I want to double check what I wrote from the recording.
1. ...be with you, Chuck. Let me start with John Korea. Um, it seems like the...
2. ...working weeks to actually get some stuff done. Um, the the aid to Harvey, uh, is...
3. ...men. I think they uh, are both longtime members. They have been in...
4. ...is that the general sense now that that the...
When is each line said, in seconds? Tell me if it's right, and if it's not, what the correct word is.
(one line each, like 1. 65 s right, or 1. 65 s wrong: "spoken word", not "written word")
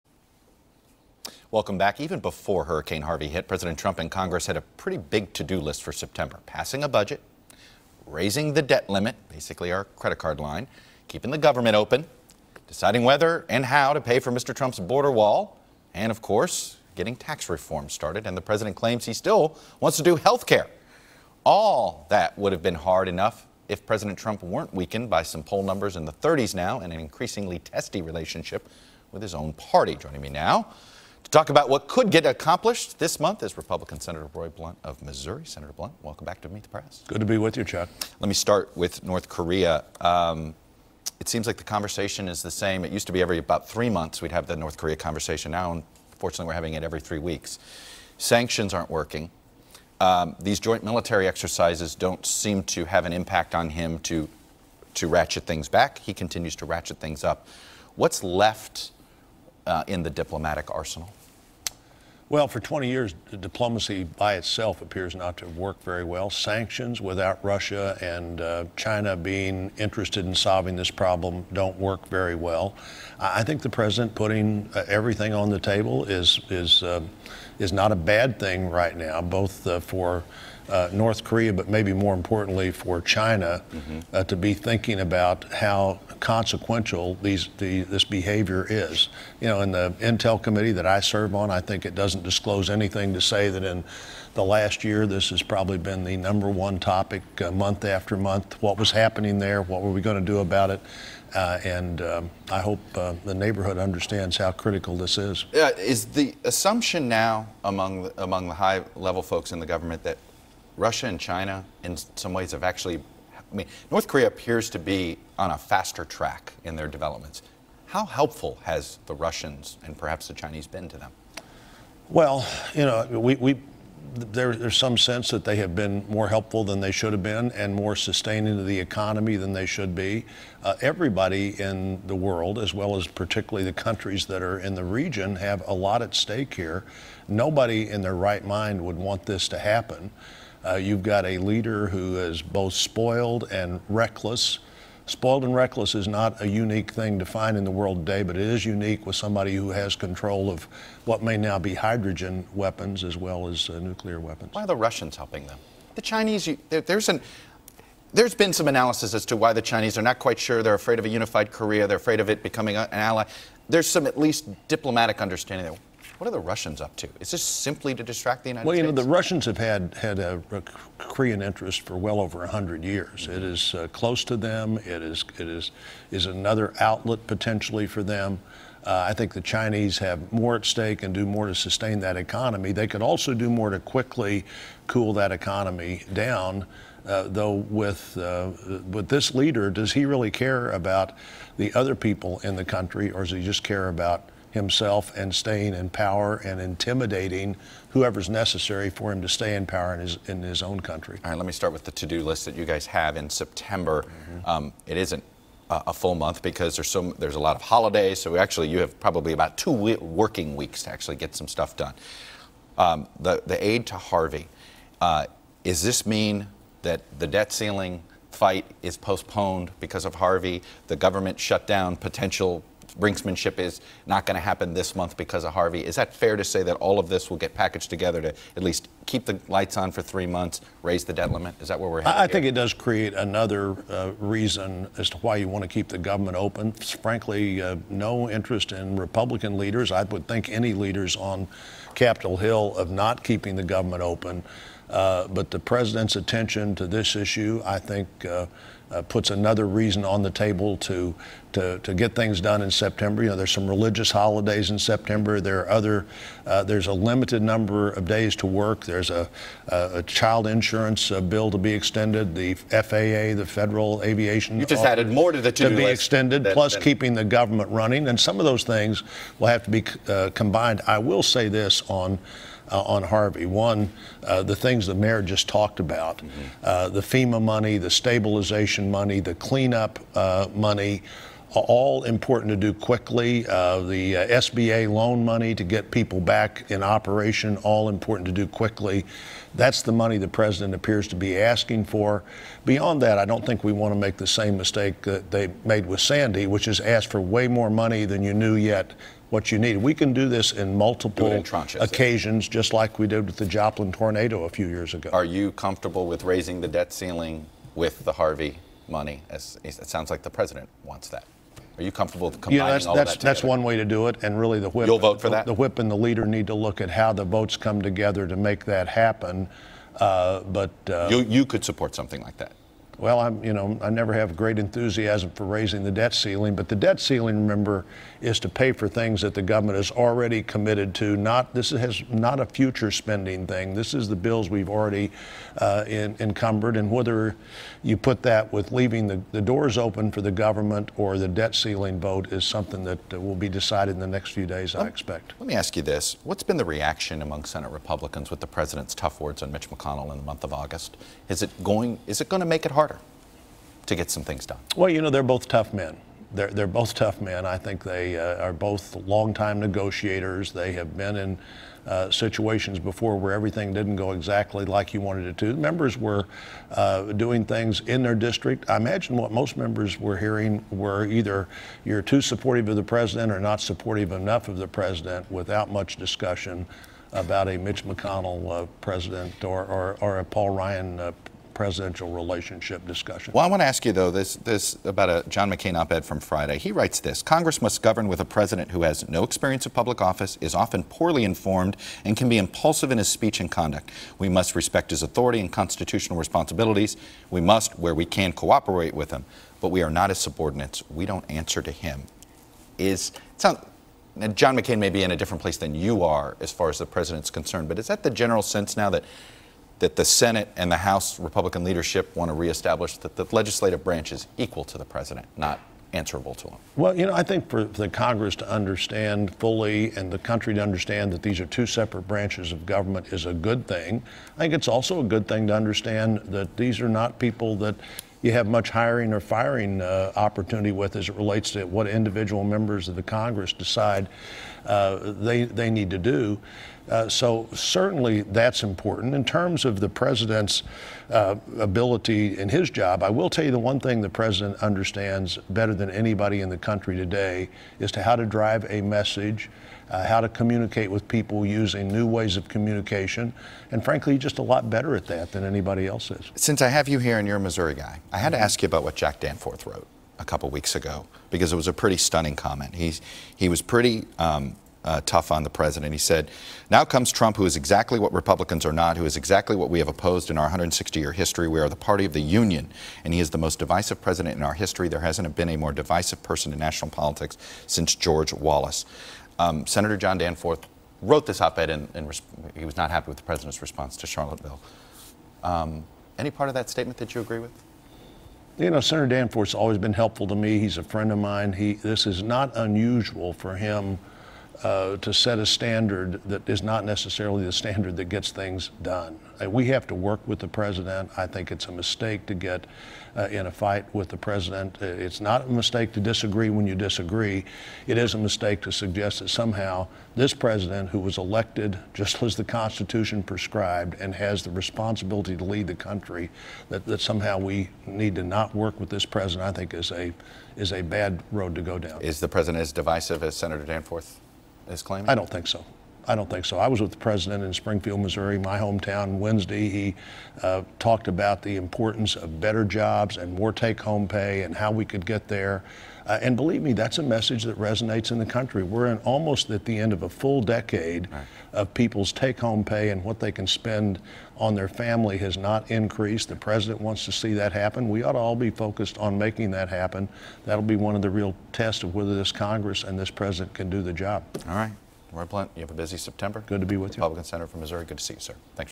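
1. 37 s wrong: "North", not "John"
2. 209 s right
3. 357 s wrong: "negotiators", not "members"
4. 407 s right.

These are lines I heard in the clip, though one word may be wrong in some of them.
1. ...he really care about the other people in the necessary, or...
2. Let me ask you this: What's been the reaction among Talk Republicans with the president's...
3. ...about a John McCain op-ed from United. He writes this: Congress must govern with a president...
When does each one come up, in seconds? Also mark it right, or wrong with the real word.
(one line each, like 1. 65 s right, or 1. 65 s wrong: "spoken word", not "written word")
1. 189 s wrong: "country", not "necessary"
2. 345 s wrong: "Senate", not "Talk"
3. 384 s wrong: "Friday", not "United".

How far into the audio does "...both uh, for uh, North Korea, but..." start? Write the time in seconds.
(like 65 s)
79 s.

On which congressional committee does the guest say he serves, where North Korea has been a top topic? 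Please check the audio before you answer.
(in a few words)
Intel committee.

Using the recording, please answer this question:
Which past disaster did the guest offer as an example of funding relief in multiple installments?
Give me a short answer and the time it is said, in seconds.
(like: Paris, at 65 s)
Joplin tornado, at 303 s.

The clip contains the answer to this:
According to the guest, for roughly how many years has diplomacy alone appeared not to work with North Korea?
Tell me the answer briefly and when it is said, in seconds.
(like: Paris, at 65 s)
20, at 62 s.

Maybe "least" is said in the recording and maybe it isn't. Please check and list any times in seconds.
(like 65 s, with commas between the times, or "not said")
164 s, 228 s.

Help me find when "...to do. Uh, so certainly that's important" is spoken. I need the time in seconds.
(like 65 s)
435 s.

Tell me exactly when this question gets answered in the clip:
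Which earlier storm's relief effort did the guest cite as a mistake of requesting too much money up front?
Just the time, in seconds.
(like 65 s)
295 s.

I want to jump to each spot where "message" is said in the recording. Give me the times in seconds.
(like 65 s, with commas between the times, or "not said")
448 s, 537 s.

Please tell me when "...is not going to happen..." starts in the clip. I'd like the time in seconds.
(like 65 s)
223 s.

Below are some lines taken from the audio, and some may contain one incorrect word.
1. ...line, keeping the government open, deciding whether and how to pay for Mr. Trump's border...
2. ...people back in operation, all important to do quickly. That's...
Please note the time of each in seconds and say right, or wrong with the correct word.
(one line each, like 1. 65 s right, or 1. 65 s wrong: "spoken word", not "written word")
1. 10 s right
2. 285 s right.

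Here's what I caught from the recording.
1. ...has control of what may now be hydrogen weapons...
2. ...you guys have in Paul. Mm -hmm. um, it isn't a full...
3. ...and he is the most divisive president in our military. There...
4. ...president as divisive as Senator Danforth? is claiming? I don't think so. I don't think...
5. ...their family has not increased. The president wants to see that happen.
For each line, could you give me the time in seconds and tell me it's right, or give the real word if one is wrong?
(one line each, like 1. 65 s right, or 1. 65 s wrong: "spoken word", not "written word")
1. 149 s right
2. 202 s wrong: "September", not "Paul"
3. 473 s wrong: "history", not "military"
4. 522 s right
5. 544 s right.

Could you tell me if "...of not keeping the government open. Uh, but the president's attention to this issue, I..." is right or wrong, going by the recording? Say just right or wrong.
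right.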